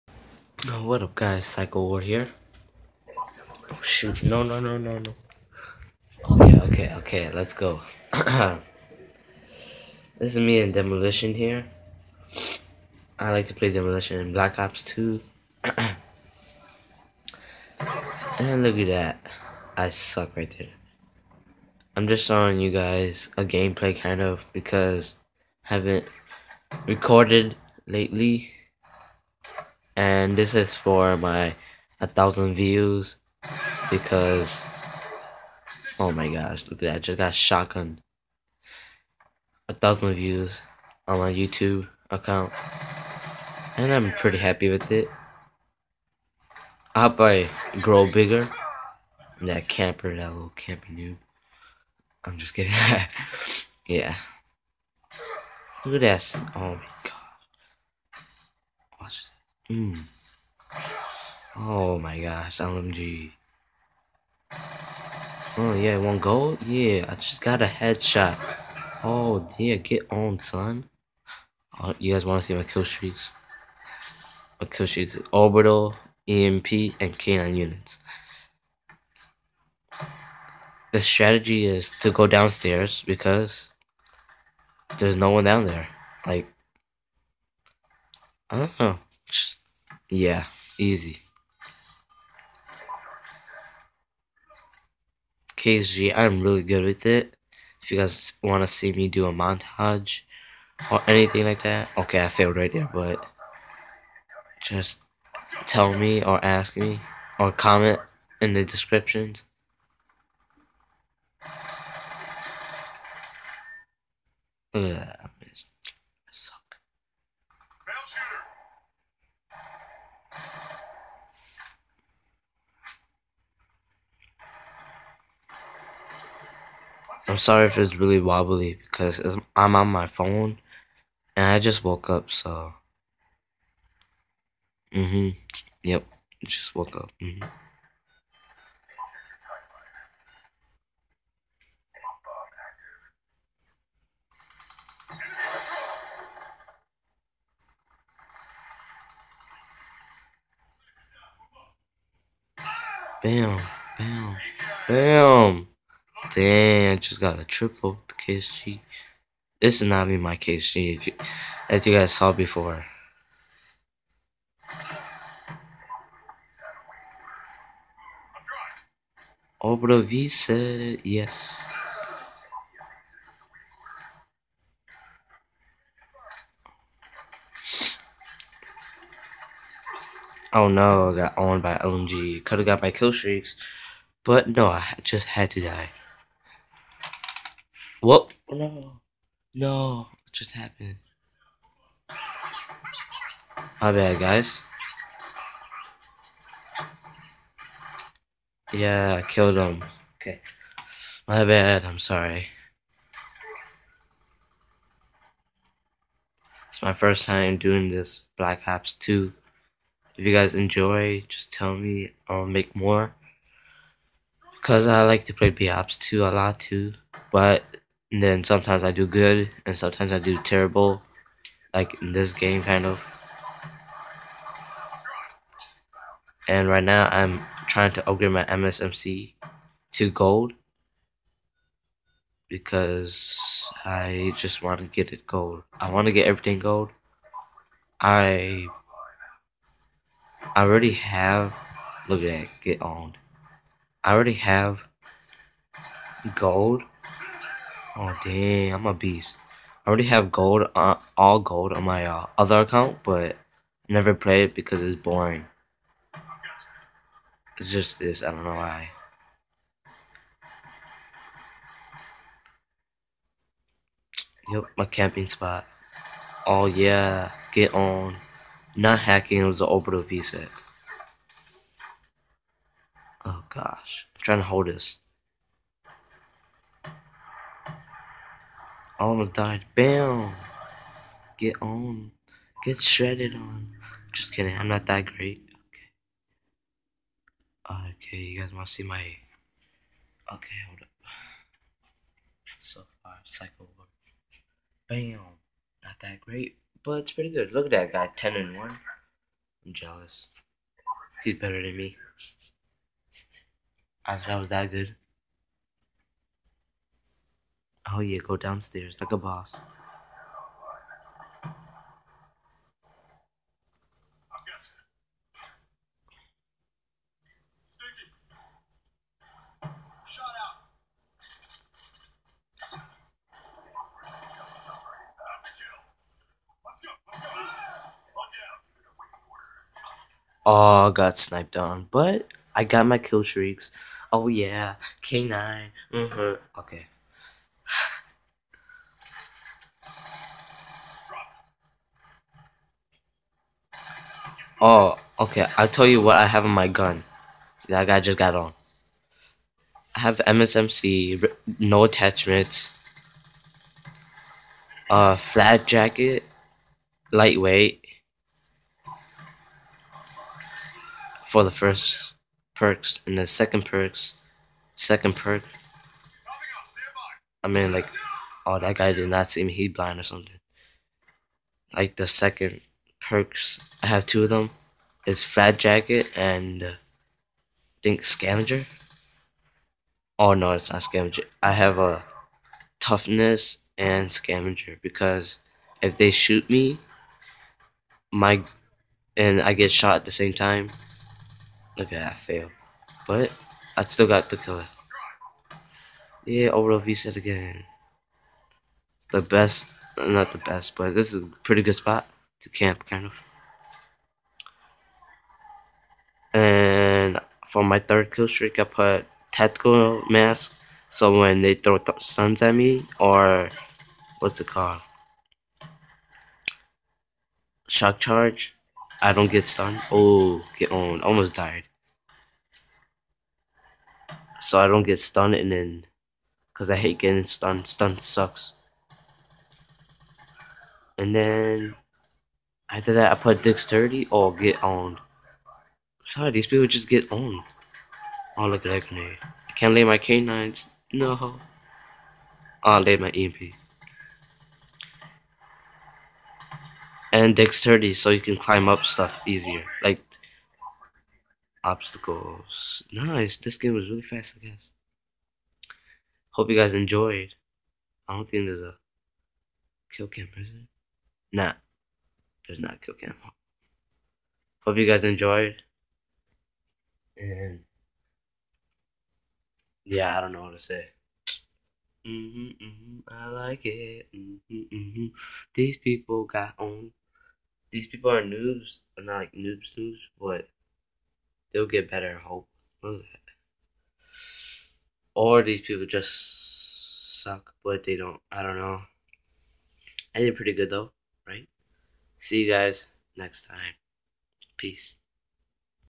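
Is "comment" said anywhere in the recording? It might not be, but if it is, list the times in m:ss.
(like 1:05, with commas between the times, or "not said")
1:47.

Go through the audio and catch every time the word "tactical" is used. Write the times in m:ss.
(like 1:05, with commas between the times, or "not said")
6:49.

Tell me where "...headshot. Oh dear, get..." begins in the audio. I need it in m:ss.
1:07.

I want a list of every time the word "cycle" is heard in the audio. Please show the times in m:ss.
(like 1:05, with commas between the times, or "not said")
4:53.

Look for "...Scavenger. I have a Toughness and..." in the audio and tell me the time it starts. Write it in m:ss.
6:20.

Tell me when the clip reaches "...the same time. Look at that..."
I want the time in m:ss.
6:30.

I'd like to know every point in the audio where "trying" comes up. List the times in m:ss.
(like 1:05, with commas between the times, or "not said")
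3:47, 4:34.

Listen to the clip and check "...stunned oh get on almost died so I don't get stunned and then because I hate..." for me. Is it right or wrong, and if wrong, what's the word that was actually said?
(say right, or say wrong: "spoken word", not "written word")
right.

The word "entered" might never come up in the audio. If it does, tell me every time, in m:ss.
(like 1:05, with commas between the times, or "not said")
not said.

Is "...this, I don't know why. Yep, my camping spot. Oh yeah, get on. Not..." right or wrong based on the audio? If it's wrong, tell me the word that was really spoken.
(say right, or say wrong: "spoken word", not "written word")
right.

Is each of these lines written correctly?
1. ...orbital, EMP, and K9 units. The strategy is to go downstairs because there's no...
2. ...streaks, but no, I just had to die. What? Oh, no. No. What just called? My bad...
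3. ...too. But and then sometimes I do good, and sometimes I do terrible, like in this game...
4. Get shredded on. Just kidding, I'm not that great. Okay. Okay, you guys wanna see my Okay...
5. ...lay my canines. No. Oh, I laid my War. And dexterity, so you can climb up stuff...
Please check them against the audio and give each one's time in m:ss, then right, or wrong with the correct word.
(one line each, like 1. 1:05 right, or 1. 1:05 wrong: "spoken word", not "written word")
1. 1:15 right
2. 3:03 wrong: "happened", not "called"
3. 3:36 right
4. 4:42 right
5. 7:19 wrong: "EMP", not "War".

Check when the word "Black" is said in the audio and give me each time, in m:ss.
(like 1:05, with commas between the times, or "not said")
0:14, 3:28.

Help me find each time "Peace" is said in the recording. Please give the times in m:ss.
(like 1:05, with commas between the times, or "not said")
8:14.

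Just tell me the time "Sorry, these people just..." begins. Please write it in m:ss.
7:16.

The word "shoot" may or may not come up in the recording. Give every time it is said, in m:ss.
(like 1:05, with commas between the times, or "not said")
0:03, 6:26.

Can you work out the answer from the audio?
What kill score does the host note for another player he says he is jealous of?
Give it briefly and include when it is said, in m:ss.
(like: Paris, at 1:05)
10 and 1, at 4:58.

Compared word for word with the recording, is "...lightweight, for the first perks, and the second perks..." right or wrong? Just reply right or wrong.
right.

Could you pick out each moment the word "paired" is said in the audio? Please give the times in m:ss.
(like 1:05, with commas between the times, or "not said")
not said.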